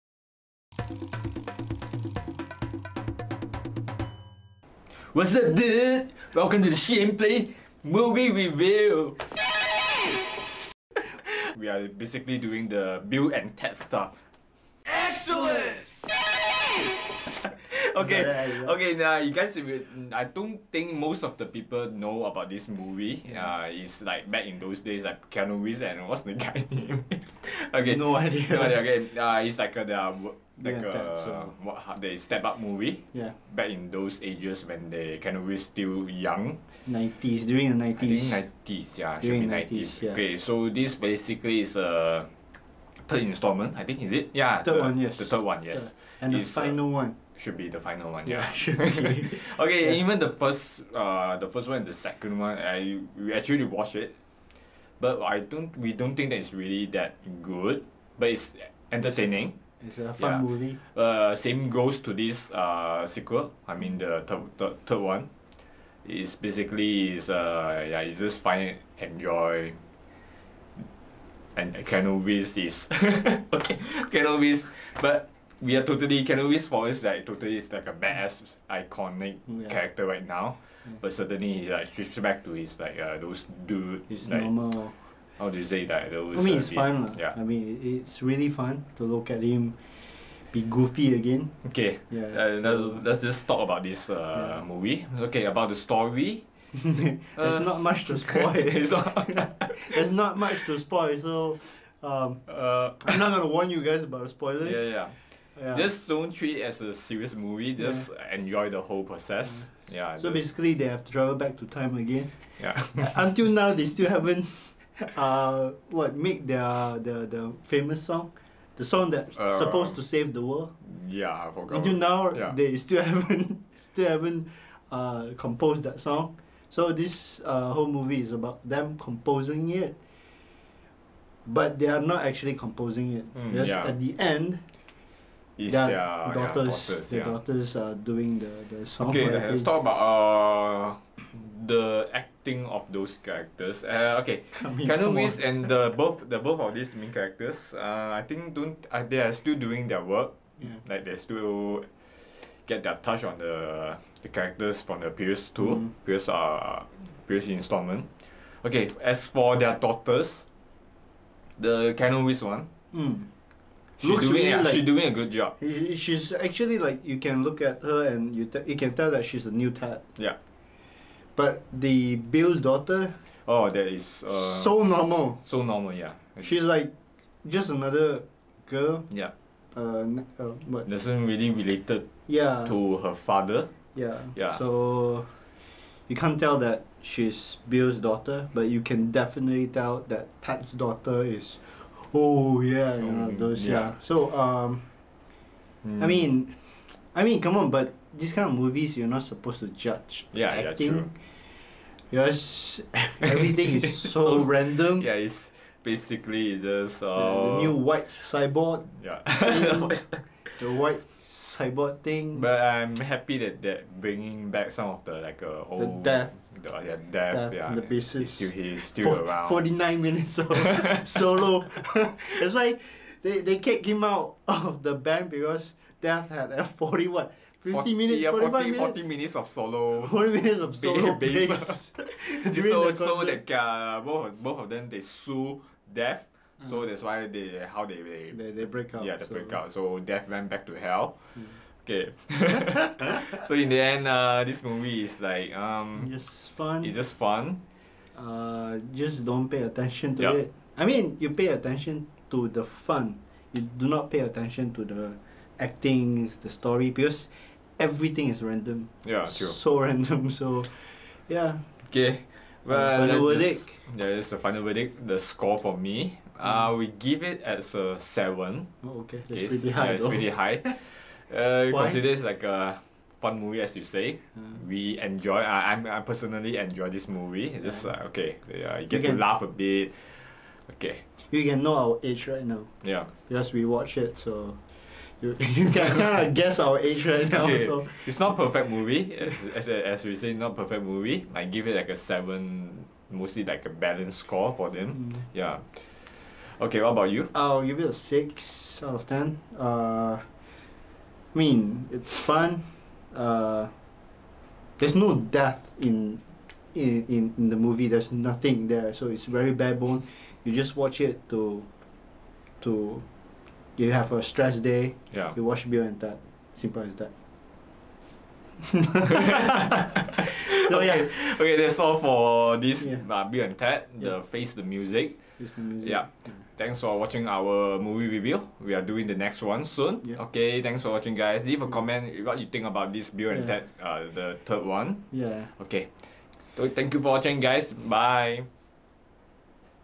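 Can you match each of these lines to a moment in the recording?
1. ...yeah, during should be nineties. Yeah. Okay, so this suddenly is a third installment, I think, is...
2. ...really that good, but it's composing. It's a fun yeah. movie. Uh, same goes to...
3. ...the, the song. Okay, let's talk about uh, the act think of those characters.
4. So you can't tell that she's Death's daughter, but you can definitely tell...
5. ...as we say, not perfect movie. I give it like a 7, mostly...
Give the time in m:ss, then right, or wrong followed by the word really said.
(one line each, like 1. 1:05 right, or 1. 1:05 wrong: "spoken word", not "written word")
1. 0:38 wrong: "basically", not "suddenly"
2. 0:56 wrong: "entertaining", not "composing"
3. 2:18 right
4. 3:04 wrong: "Bill", not "Death"
5. 4:49 right.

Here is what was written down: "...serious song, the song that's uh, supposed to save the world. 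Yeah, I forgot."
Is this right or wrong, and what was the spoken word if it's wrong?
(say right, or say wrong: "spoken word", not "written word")
wrong: "famous", not "serious".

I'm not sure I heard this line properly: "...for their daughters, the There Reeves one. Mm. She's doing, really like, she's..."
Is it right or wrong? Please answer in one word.
wrong.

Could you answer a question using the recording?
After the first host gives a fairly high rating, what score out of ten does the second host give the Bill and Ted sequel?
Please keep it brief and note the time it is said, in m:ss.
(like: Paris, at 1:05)
6 out of 10, at 4:57.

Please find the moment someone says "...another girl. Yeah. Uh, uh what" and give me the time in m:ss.
2:57.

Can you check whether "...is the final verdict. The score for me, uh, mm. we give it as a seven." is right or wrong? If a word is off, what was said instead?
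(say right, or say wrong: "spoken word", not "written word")
right.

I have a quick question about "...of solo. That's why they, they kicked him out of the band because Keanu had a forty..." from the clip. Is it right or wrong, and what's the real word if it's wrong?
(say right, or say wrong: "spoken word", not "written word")
wrong: "Death", not "Keanu".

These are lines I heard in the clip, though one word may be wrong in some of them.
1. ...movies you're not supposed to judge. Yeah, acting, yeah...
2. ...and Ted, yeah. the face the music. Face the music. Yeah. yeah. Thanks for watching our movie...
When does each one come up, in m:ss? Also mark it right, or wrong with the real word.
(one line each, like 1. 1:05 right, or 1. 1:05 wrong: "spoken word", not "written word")
1. 3:18 right
2. 5:23 right.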